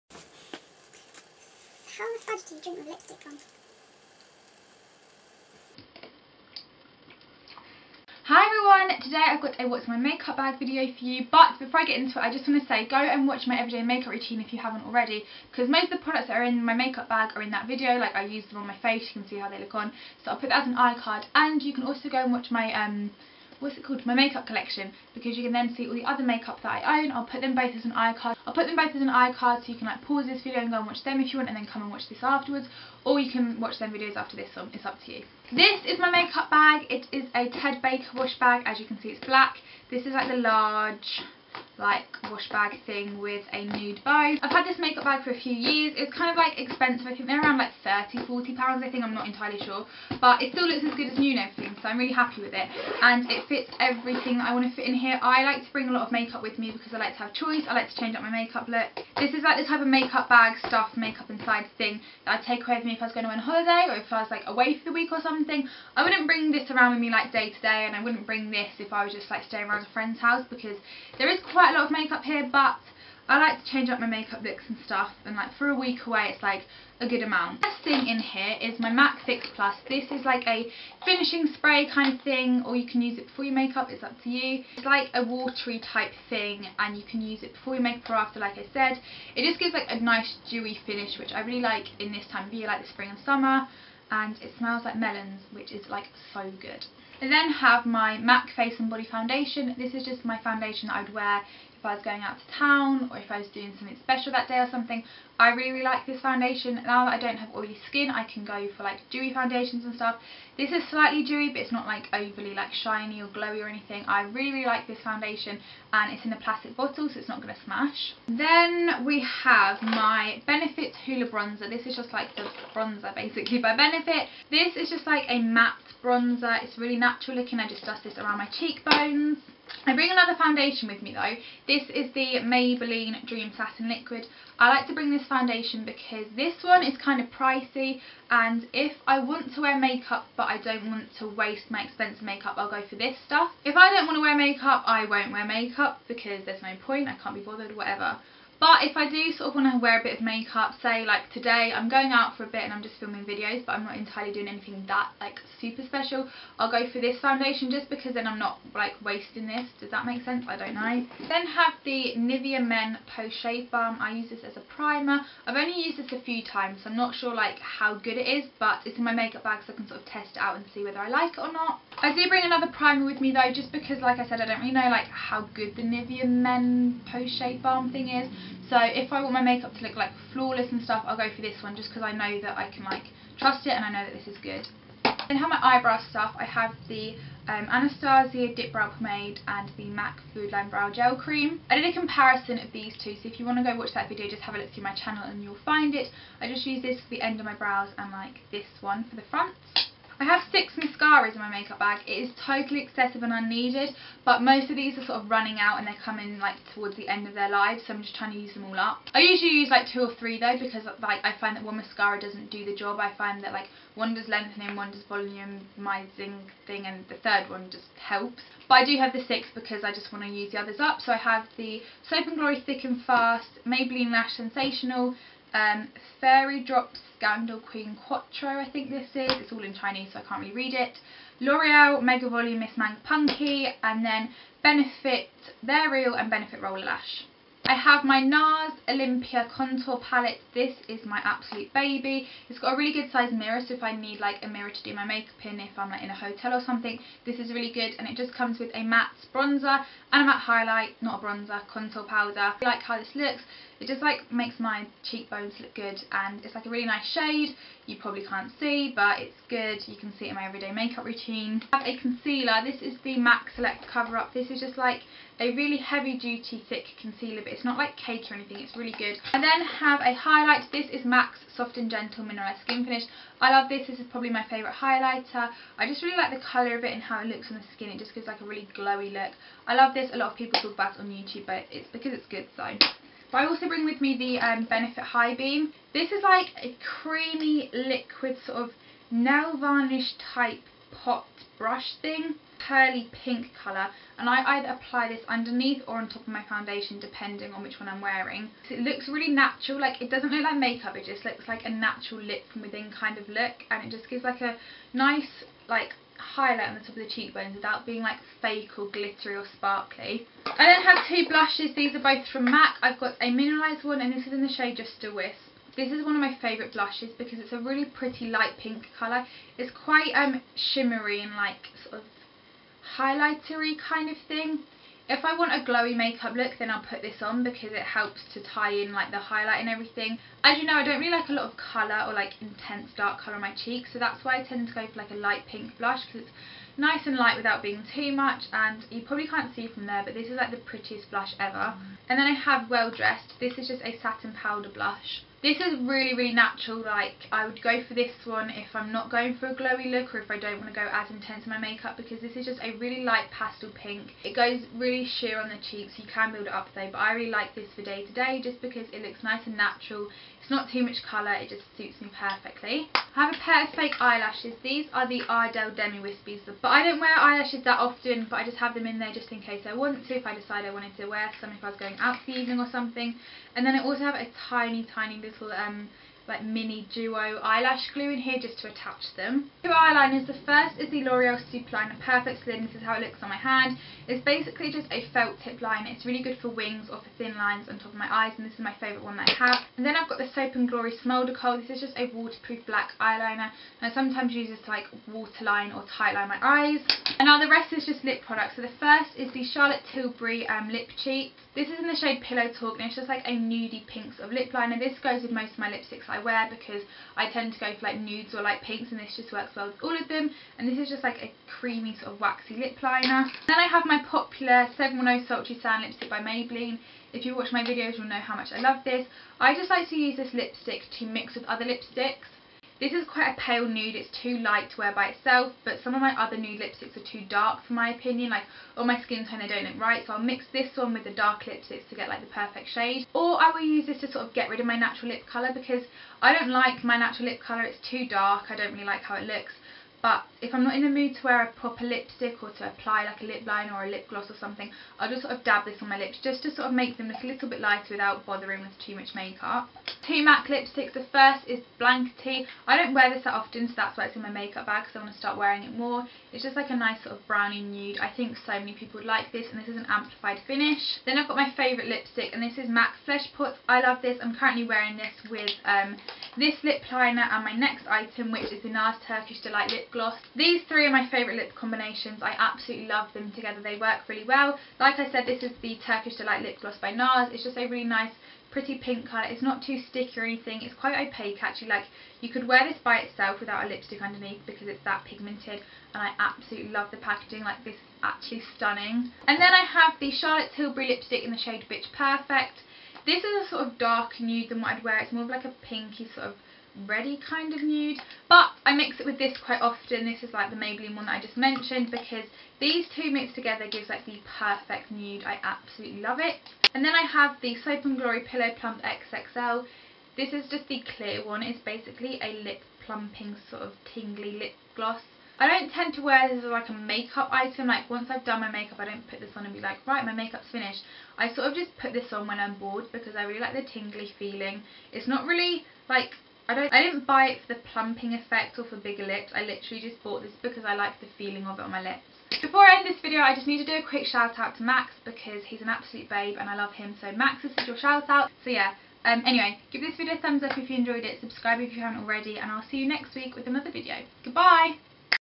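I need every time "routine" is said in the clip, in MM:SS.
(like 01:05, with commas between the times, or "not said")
00:14, 04:21.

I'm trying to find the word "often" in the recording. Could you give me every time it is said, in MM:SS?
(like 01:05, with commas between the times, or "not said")
06:07, 07:33, 08:19.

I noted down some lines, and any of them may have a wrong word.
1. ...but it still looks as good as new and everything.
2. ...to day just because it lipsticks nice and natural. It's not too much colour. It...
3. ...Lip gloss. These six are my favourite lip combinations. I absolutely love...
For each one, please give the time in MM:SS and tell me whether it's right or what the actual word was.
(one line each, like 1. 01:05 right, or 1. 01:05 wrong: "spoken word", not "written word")
1. 00:50 right
2. 05:58 wrong: "looks", not "lipsticks"
3. 07:49 wrong: "three", not "six".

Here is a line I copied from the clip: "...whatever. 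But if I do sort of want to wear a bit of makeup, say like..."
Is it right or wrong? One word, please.
right.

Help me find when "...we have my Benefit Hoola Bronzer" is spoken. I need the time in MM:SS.
01:59.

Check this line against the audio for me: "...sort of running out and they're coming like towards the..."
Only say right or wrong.
right.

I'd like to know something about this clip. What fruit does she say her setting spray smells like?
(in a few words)
Melons.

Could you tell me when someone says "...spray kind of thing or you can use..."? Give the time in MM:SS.
01:21.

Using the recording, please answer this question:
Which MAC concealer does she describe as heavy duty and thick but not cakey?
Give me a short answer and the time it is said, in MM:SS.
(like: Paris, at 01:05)
MAC Select Cover Up, at 04:23.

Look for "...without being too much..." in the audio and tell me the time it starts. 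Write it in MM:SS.
05:37.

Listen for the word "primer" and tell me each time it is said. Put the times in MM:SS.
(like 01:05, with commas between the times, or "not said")
02:44, 02:52.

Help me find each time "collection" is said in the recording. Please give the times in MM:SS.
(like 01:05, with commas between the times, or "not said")
00:24.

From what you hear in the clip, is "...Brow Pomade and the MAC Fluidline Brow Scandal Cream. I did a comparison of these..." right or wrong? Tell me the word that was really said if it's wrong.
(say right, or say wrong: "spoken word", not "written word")
wrong: "Gel", not "Scandal".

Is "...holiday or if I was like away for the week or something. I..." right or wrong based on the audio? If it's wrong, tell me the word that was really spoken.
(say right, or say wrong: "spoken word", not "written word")
right.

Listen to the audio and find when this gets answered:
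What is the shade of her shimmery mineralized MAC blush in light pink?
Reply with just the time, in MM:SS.
05:14.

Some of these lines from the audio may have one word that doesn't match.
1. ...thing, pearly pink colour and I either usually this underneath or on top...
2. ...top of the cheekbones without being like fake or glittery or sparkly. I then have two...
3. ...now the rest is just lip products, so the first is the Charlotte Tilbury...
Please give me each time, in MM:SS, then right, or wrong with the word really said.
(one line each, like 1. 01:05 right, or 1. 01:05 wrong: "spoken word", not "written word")
1. 04:52 wrong: "apply", not "usually"
2. 05:06 right
3. 06:37 right.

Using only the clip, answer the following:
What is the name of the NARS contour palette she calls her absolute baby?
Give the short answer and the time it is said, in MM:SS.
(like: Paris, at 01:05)
Olympia, at 03:58.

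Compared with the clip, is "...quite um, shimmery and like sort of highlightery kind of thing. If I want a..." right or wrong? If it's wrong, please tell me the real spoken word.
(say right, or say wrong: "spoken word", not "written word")
right.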